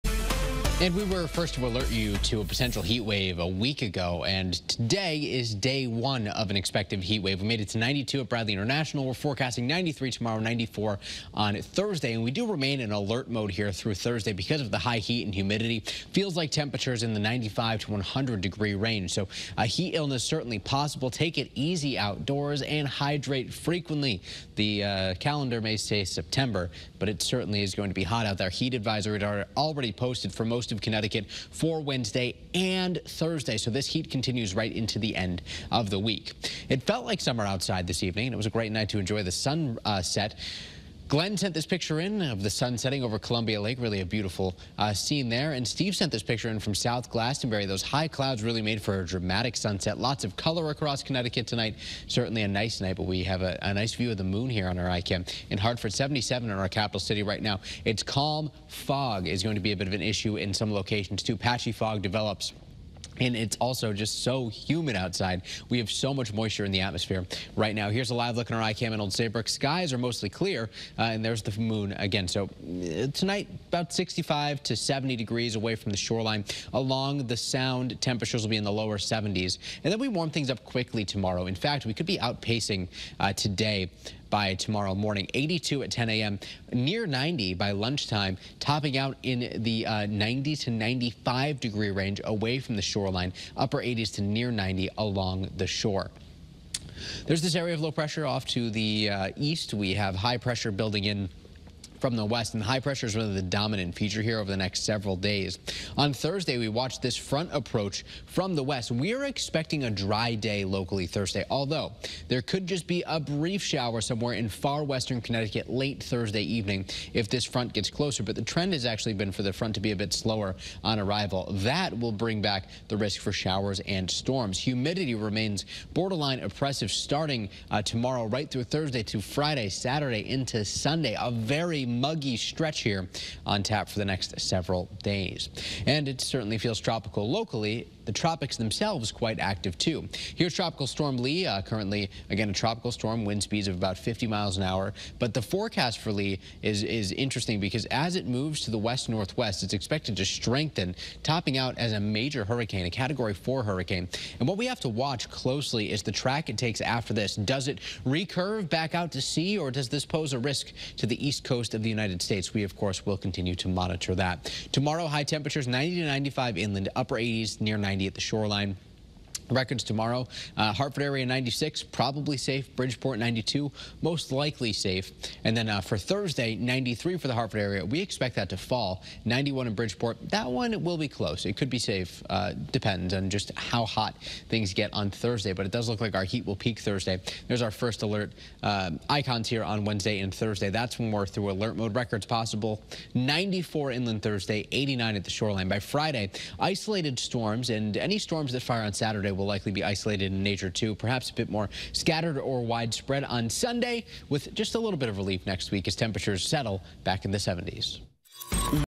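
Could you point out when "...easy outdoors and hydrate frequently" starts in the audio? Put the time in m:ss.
0:21.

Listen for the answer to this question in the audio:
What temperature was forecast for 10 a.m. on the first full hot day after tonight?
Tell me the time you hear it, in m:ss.
1:25.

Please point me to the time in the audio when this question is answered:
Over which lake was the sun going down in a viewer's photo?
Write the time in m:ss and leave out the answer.
0:43.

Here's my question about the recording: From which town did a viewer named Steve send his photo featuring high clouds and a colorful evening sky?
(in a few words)
South Glastonbury.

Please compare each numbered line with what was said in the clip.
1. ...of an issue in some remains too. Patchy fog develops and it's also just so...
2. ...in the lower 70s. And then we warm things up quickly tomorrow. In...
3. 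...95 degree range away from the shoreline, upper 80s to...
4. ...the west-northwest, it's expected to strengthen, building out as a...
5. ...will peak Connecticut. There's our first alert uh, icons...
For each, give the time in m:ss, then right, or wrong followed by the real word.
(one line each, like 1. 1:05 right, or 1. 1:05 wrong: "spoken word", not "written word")
1. 0:59 wrong: "locations", not "remains"
2. 1:18 right
3. 1:30 right
4. 2:28 wrong: "topping", not "building"
5. 3:06 wrong: "Thursday", not "Connecticut".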